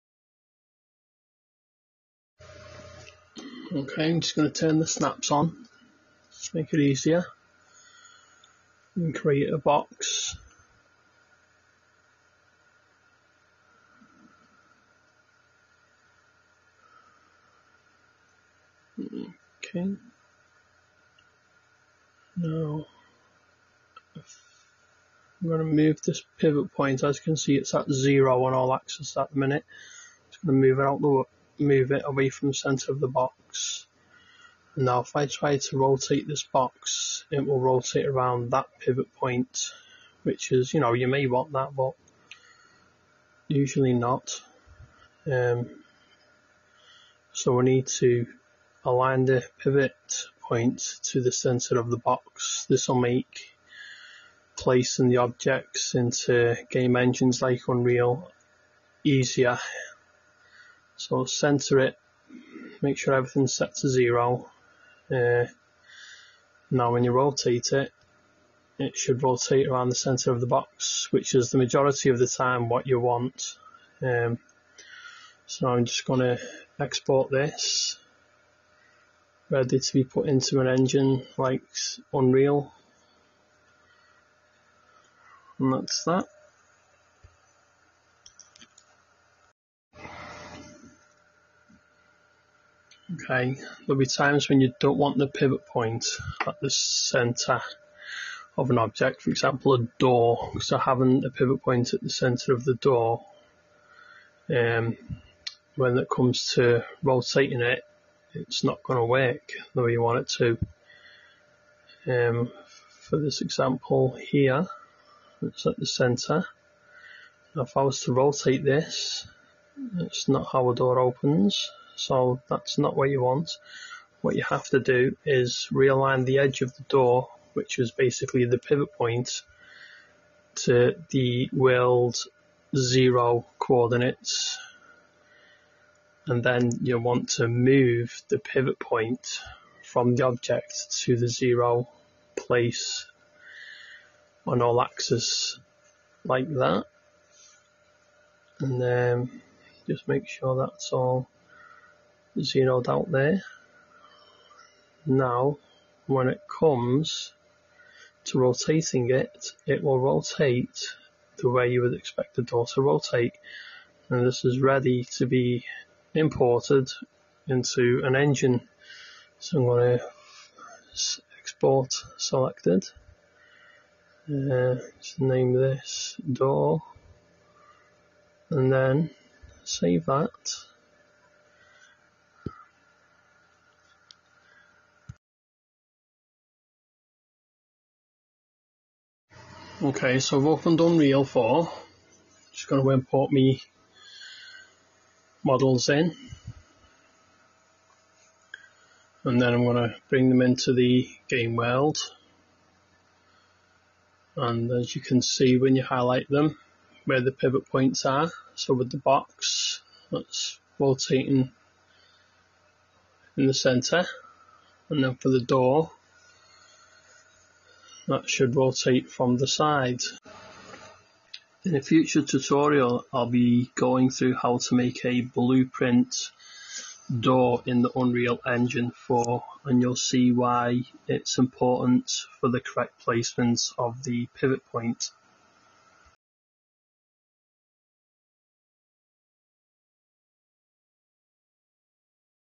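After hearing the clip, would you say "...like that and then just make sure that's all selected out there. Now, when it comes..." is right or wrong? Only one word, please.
wrong.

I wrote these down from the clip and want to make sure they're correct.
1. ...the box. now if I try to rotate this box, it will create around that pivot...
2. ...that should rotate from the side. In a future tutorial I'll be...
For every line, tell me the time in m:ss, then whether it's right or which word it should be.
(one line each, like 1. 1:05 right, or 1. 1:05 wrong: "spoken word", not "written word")
1. 0:32 wrong: "rotate", not "create"
2. 3:38 right.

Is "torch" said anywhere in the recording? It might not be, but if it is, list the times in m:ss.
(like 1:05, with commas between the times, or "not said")
not said.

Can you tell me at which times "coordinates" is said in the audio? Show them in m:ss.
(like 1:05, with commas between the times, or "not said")
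2:13.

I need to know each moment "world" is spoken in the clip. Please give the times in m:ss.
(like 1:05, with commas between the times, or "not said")
2:11, 3:21.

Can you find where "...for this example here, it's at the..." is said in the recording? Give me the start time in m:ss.
1:53.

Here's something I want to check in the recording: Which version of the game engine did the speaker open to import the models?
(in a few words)
Unreal 4.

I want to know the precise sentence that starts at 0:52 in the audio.
This will make placing the objects into game engines like Unreal easier so center it, make sure everything's set to zero.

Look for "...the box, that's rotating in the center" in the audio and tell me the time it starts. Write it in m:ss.
3:28.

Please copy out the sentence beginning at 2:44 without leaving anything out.
And this is ready to be imported into an engine.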